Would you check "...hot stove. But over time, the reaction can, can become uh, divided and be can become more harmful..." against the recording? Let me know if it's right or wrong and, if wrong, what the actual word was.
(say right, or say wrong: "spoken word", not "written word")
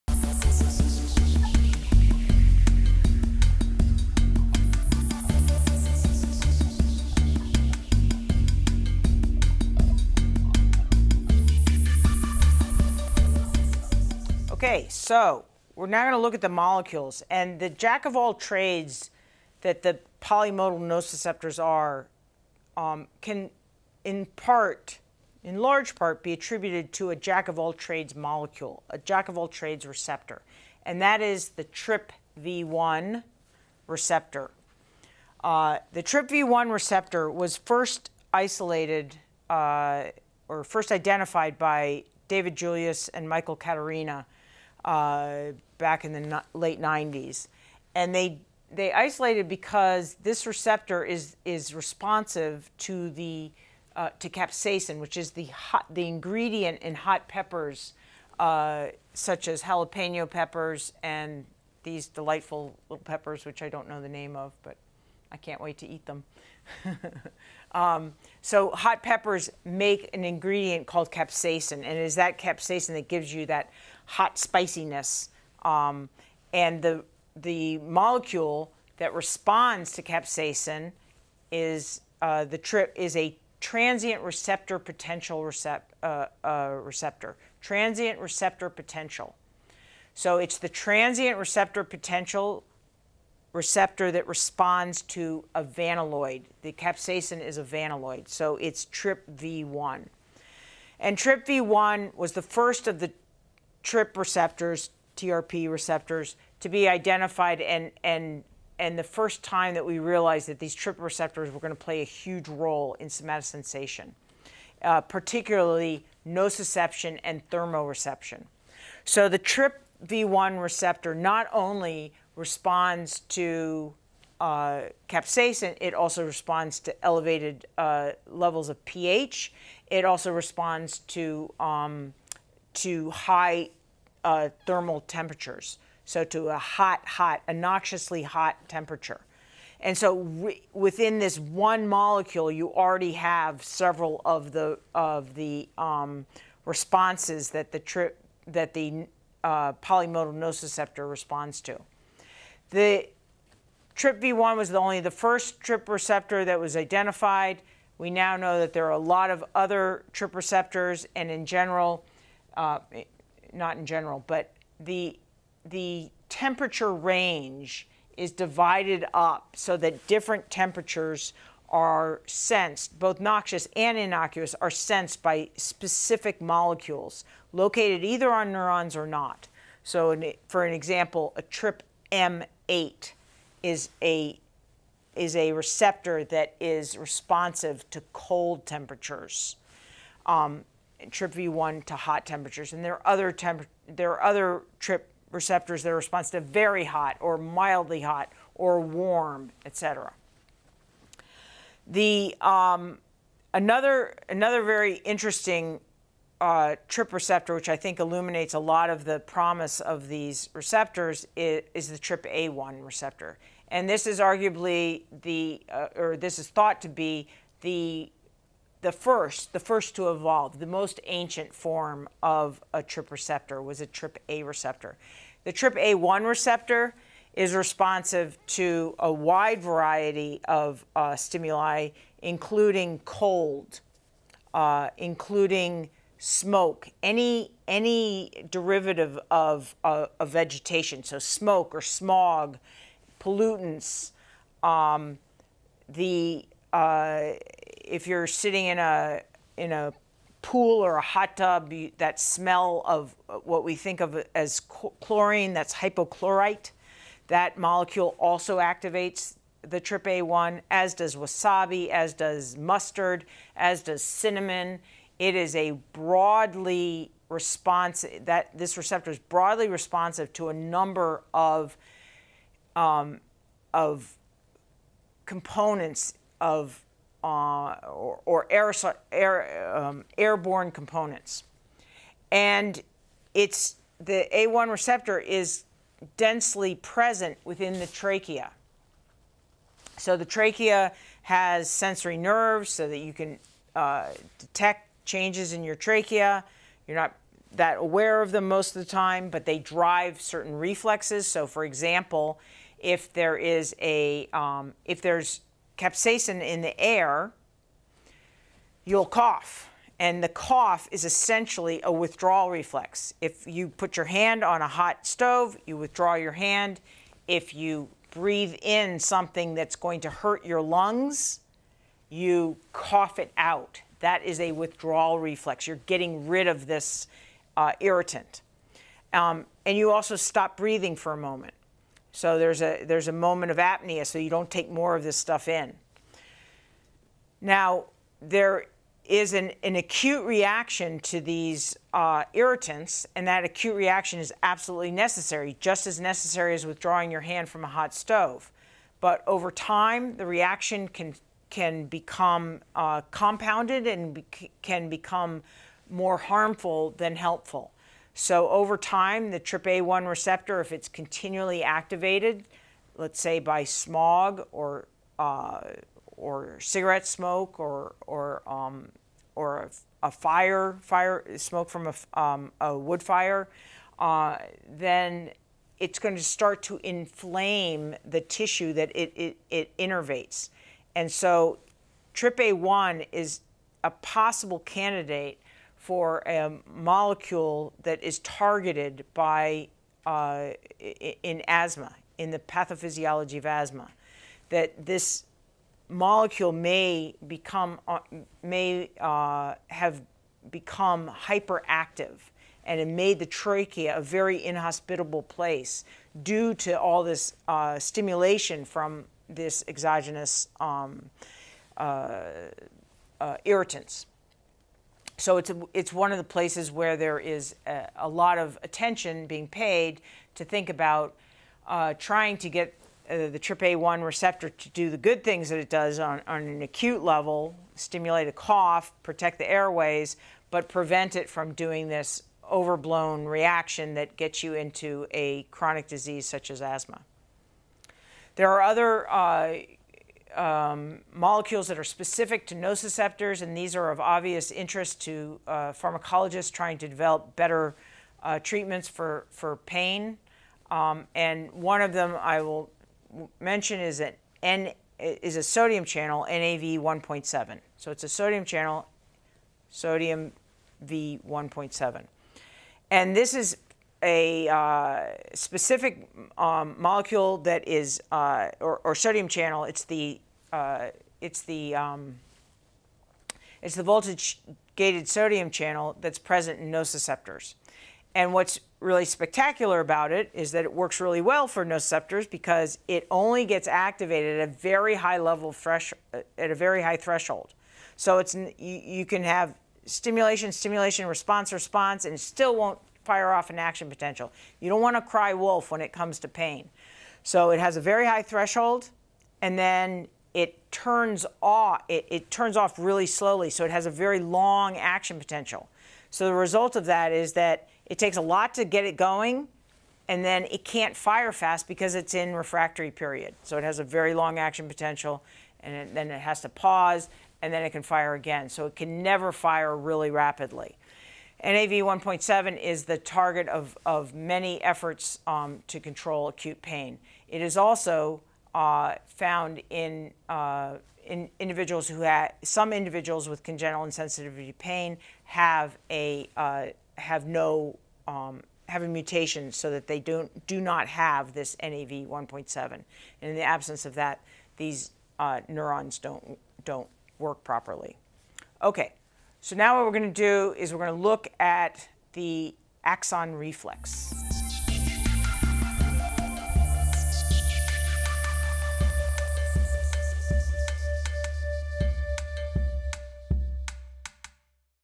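wrong: "compounded", not "divided".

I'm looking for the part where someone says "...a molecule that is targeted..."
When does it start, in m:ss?
6:26.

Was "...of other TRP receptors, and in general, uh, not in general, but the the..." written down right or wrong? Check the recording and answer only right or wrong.
right.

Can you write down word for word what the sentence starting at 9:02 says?
And in the absence of that, these uh, neurons don't, don't work properly.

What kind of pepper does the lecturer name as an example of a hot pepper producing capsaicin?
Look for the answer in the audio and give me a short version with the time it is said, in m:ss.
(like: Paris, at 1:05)
jalapeno, at 0:59.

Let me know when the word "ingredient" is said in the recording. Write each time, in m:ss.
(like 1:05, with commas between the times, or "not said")
0:56, 1:10.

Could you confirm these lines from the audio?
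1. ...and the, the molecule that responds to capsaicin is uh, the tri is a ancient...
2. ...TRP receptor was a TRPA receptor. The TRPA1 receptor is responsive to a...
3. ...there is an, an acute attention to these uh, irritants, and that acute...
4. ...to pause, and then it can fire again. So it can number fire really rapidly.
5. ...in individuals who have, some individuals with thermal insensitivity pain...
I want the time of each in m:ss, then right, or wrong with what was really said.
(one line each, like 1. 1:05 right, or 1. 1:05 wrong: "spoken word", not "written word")
1. 1:16 wrong: "transient", not "ancient"
2. 3:42 right
3. 5:38 wrong: "reaction", not "attention"
4. 8:36 wrong: "never", not "number"
5. 8:51 wrong: "congenital", not "thermal".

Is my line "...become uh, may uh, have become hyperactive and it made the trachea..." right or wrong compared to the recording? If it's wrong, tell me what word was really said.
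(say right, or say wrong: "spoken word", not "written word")
right.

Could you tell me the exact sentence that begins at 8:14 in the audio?
You don't want to cry wolf when it comes to pain.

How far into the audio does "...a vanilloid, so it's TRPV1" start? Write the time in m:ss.
1:37.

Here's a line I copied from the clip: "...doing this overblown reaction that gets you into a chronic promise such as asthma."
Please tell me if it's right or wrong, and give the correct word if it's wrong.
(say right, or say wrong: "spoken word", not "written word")
wrong: "disease", not "promise".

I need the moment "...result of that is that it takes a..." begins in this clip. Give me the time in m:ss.
8:26.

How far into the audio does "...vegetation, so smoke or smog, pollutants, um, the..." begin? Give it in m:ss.
4:00.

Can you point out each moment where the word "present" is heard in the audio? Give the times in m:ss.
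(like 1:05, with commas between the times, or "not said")
4:46, 7:56.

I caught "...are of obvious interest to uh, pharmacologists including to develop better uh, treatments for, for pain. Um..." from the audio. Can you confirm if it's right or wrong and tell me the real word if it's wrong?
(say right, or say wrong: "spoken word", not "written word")
wrong: "trying", not "including".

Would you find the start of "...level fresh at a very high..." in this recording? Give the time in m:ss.
8:05.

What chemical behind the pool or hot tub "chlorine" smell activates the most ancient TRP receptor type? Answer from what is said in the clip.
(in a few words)
hypochlorite.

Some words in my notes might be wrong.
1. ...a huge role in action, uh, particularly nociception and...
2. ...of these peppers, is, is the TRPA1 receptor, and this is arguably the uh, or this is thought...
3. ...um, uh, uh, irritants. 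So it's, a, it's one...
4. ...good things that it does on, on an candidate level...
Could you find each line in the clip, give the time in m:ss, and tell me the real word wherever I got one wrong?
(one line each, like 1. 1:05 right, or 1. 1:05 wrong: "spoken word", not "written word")
1. 1:52 wrong: "somatosensation", not "action"
2. 3:29 wrong: "receptors", not "peppers"
3. 6:50 right
4. 7:04 wrong: "acute", not "candidate".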